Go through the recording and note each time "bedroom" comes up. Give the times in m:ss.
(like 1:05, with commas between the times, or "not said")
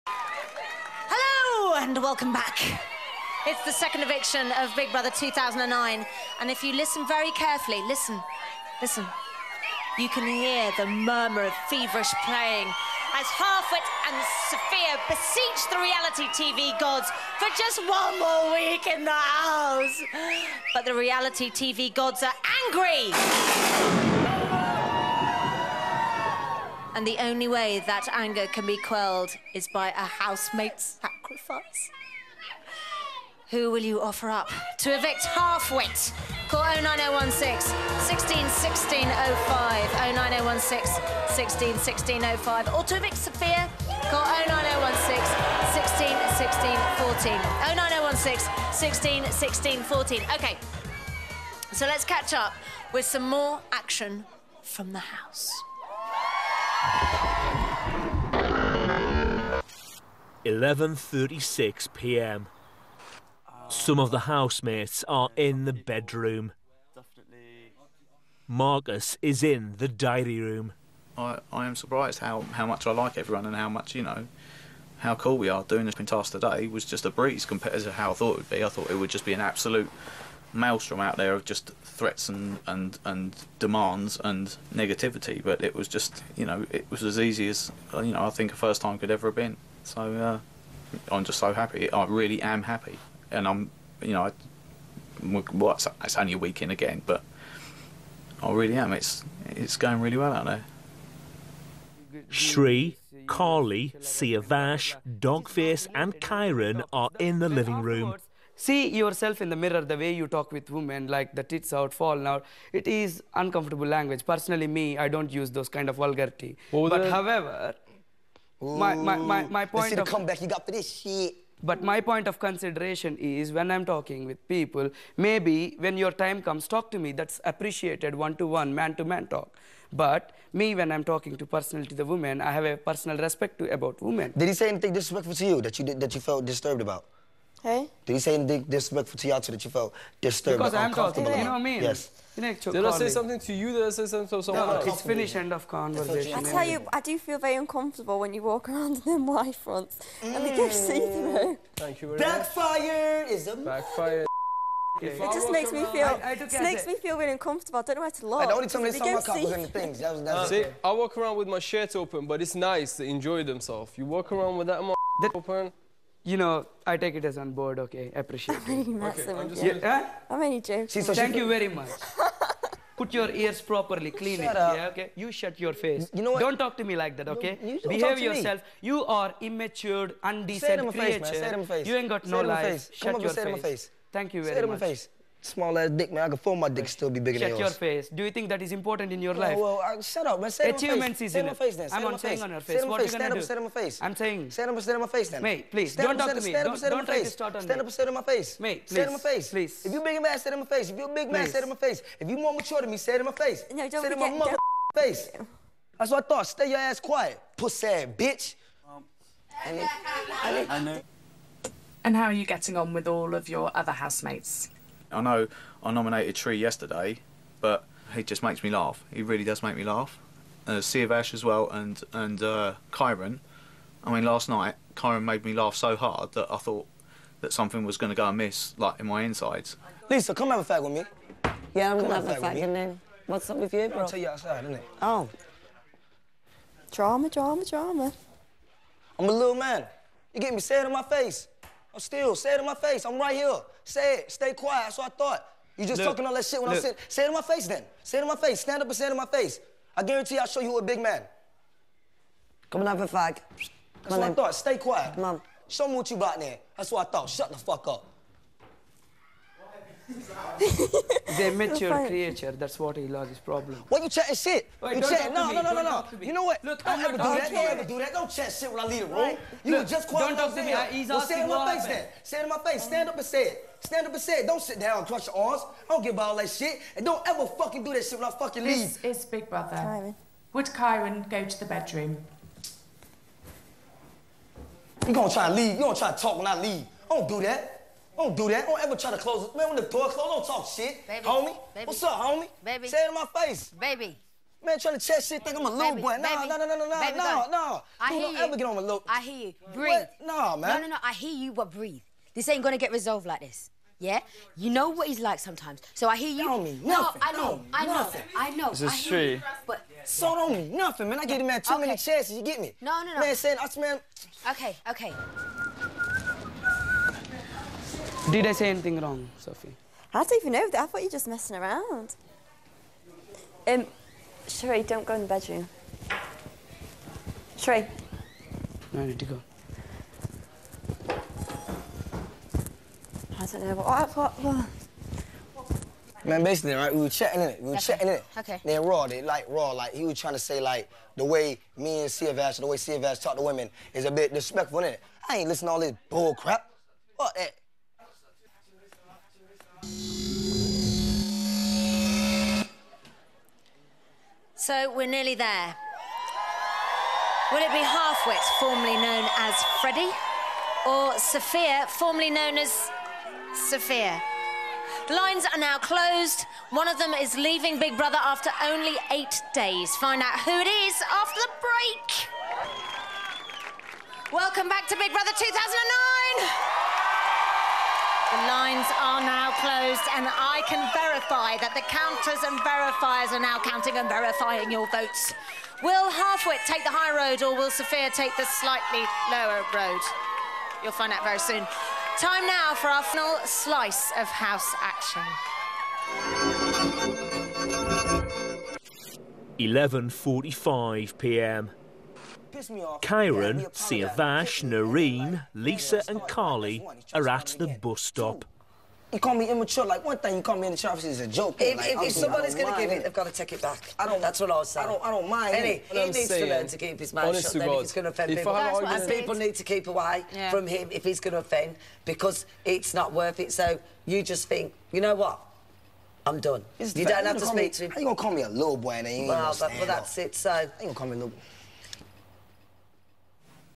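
1:05, 4:41, 5:25.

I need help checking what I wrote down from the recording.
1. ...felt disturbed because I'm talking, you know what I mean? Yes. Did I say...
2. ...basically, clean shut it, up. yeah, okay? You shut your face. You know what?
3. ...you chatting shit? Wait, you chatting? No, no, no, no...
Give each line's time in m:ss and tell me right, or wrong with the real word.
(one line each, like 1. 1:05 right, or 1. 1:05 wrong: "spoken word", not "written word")
1. 2:19 right
2. 2:53 wrong: "properly", not "basically"
3. 4:24 right.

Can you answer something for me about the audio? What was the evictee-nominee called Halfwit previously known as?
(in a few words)
Freddie.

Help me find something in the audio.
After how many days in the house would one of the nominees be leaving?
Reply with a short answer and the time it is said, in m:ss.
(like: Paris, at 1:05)
8, at 6:09.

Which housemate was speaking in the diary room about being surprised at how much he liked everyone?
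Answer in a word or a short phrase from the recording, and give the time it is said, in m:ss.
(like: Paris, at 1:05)
Marcus, at 1:08.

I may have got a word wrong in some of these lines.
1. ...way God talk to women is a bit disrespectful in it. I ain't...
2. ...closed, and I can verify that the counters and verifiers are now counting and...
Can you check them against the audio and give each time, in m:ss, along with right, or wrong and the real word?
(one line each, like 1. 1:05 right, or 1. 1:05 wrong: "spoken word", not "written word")
1. 5:42 wrong: "Siavash", not "God"
2. 6:19 right.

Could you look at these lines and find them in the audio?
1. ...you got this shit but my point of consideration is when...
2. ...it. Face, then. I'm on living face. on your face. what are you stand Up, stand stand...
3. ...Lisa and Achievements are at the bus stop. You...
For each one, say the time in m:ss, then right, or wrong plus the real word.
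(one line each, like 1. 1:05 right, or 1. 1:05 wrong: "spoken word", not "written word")
1. 2:00 right
2. 3:11 wrong: "saying", not "living"
3. 6:45 wrong: "Karly", not "Achievements".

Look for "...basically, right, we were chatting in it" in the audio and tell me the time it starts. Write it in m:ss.
5:36.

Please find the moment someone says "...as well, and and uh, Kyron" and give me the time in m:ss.
3:41.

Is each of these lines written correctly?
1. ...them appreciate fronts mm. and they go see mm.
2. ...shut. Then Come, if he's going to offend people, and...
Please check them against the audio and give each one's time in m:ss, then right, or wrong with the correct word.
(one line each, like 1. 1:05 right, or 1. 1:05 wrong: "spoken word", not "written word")
1. 2:29 wrong: "white", not "appreciate"
2. 6:57 wrong: "God", not "Come".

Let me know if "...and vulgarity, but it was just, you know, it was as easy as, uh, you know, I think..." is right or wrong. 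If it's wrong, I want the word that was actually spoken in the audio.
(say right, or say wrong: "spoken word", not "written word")
wrong: "negativity", not "vulgarity".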